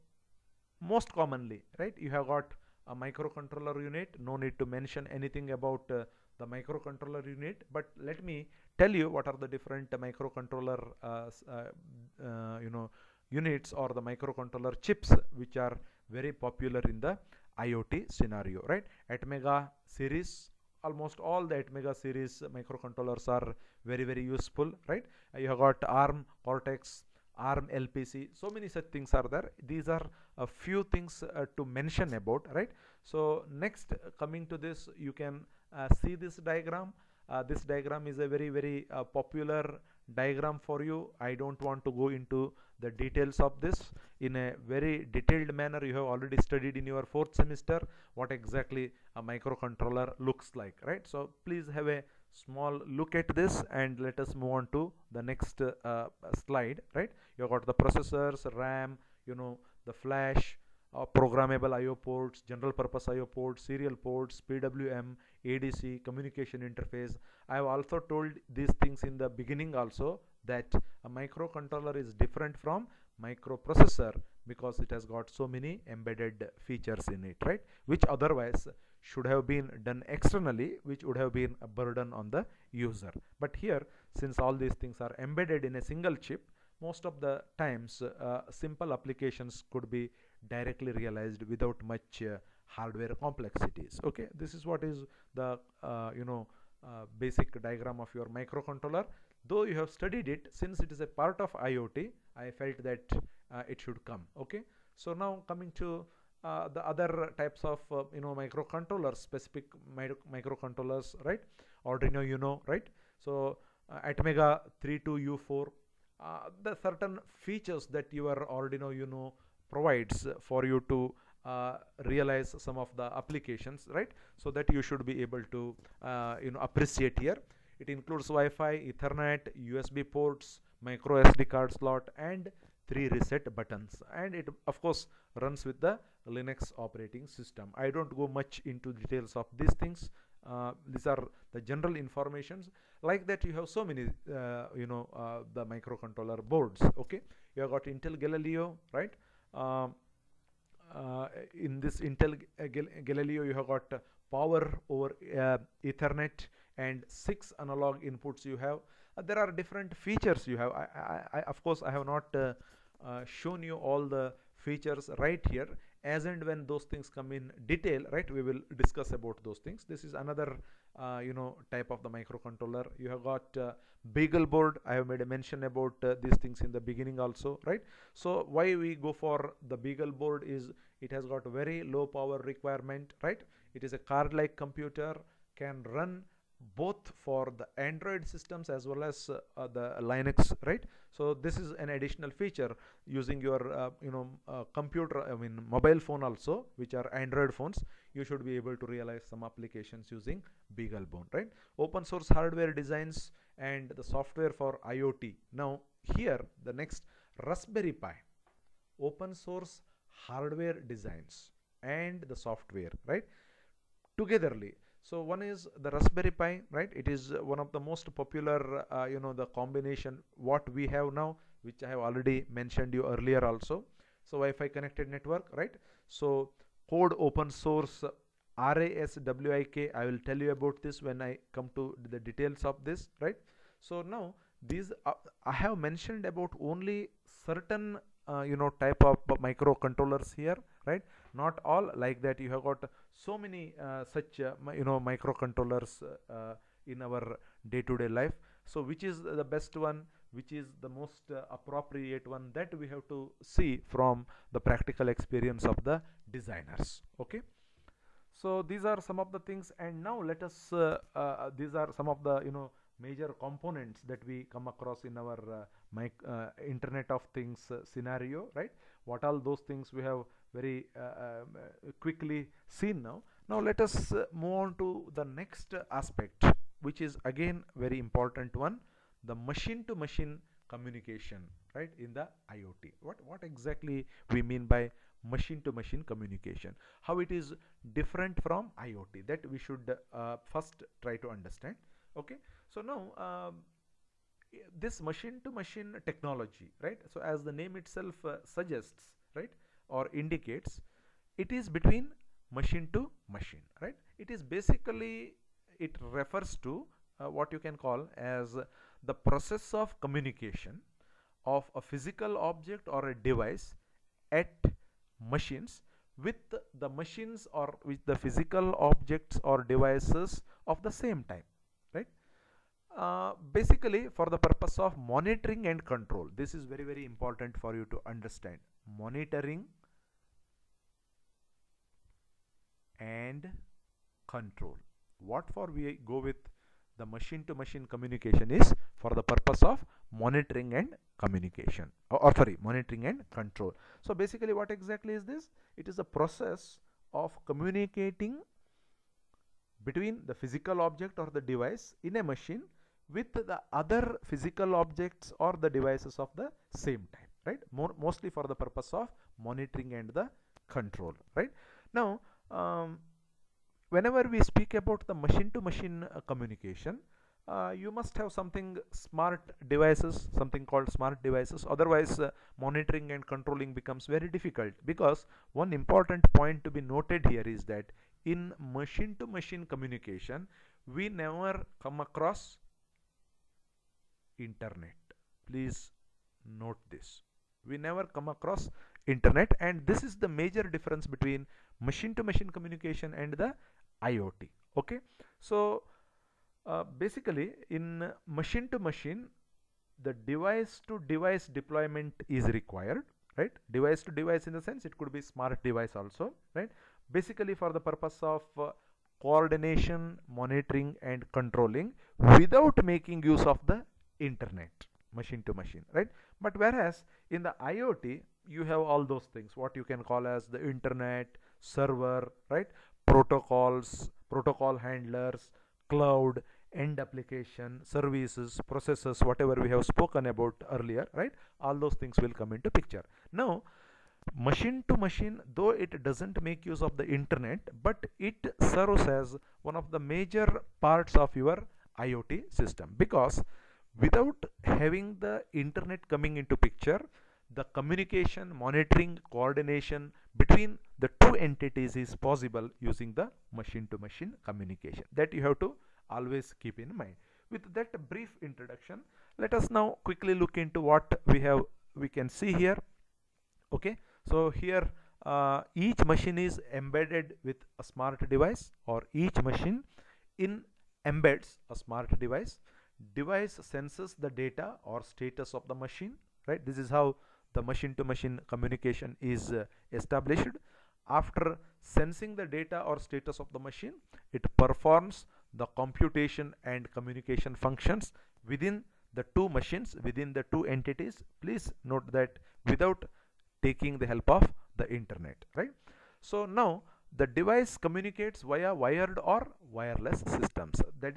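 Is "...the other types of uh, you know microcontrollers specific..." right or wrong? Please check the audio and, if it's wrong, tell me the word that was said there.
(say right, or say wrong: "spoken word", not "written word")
right.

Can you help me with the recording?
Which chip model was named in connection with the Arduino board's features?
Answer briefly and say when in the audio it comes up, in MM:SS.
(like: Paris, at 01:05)
Atmega 32U4, at 01:53.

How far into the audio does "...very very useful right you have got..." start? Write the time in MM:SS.
00:23.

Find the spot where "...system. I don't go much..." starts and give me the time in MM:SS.
02:17.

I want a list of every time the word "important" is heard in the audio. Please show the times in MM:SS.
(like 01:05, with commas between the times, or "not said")
04:37, 05:27, 06:15.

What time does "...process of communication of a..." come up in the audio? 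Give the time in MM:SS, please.
05:09.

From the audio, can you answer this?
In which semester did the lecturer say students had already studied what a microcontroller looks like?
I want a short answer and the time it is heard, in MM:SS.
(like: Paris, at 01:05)
fourth semester, at 00:47.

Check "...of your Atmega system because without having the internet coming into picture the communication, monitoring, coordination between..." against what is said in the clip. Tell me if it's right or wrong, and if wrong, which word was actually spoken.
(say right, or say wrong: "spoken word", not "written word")
wrong: "IoT", not "Atmega".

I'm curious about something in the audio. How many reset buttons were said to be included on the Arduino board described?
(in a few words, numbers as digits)
3.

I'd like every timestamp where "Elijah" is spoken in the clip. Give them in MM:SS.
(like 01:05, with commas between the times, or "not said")
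not said.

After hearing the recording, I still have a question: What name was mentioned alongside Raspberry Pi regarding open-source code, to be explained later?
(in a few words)
RASWIK.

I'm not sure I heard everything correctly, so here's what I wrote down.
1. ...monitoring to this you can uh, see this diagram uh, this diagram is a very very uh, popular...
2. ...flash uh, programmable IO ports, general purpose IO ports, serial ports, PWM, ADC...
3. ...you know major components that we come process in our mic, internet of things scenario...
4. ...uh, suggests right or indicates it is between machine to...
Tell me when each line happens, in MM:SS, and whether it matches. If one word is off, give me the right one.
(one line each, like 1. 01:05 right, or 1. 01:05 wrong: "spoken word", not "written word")
1. 00:34 wrong: "coming", not "monitoring"
2. 00:59 right
3. 04:22 wrong: "across", not "process"
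4. 04:58 right.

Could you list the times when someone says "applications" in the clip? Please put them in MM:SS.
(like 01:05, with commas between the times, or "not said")
01:28, 02:03, 03:19, 07:06.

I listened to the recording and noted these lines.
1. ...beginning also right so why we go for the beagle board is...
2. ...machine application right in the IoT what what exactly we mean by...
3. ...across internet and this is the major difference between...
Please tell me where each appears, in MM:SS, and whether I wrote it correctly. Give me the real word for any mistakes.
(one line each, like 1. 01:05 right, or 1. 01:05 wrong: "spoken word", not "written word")
1. 02:56 right
2. 04:39 wrong: "communication", not "application"
3. 06:28 right.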